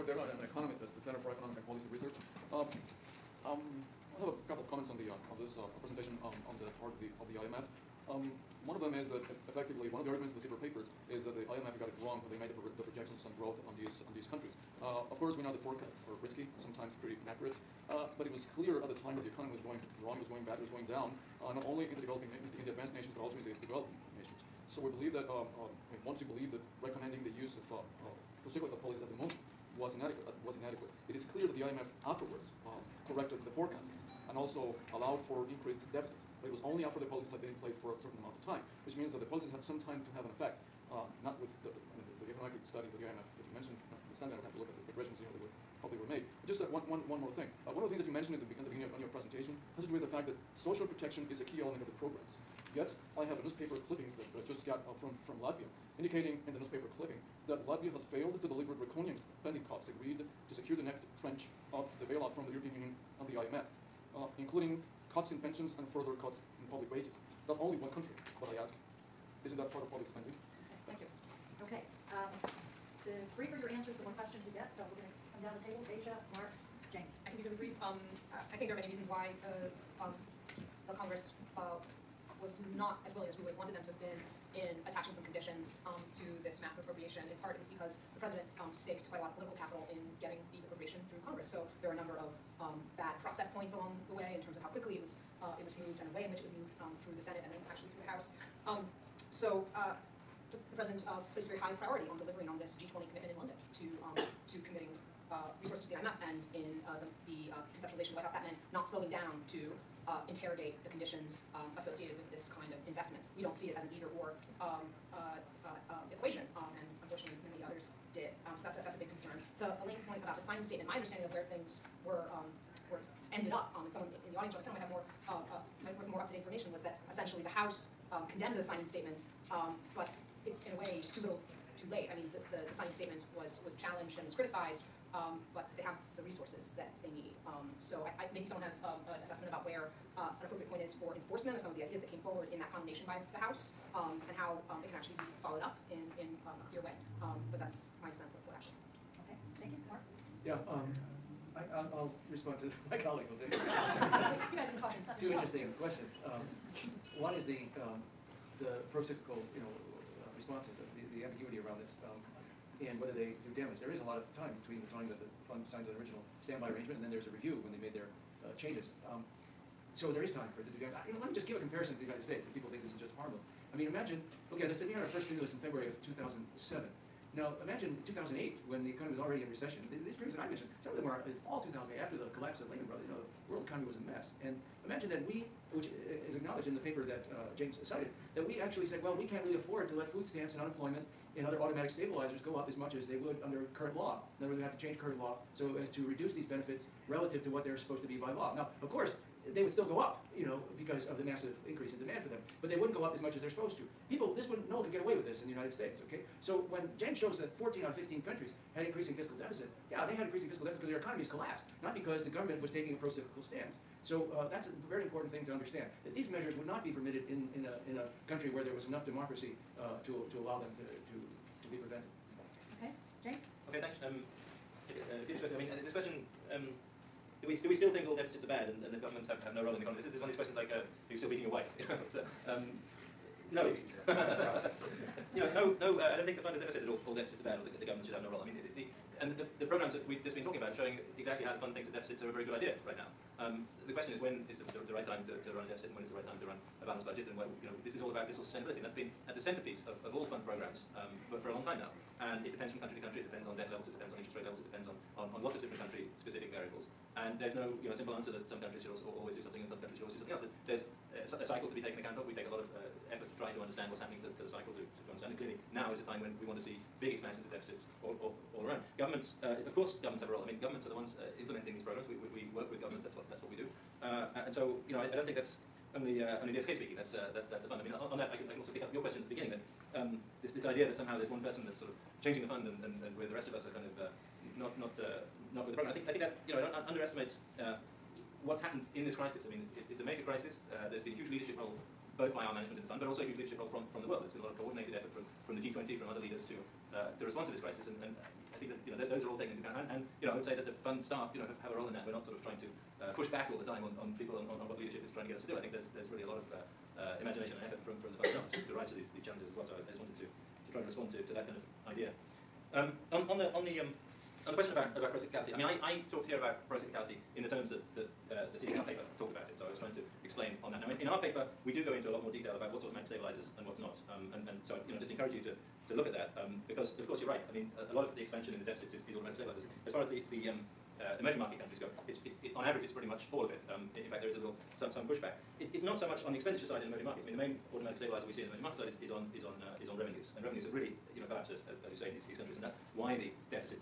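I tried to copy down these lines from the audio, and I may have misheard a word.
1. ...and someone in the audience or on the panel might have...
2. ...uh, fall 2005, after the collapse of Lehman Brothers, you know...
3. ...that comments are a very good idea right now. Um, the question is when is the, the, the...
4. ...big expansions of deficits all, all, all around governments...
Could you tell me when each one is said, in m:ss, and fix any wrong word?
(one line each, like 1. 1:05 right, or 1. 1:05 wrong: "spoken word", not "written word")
1. 2:03 right
2. 3:01 wrong: "2008", not "2005"
3. 4:01 wrong: "deficits", not "comments"
4. 4:27 right.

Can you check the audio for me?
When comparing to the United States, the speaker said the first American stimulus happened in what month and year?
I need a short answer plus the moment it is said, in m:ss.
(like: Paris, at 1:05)
February 2007, at 2:55.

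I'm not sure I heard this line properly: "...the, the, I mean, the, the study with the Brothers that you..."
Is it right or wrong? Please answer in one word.
wrong.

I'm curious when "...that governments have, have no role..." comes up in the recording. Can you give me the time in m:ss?
3:48.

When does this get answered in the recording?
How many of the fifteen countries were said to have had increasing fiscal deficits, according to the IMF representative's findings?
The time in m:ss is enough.
3:27.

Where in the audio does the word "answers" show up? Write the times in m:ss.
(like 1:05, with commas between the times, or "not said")
1:13, 4:18.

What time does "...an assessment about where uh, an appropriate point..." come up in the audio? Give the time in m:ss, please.
2:19.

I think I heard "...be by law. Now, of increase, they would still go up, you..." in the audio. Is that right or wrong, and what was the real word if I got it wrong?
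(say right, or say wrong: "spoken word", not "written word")
wrong: "course", not "increase".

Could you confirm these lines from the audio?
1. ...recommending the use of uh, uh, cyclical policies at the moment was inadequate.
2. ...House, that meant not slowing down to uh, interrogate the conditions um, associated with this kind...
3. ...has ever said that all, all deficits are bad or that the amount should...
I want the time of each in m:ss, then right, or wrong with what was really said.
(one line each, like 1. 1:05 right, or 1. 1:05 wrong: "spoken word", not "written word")
1. 0:26 right
2. 1:48 right
3. 3:56 wrong: "government", not "amount".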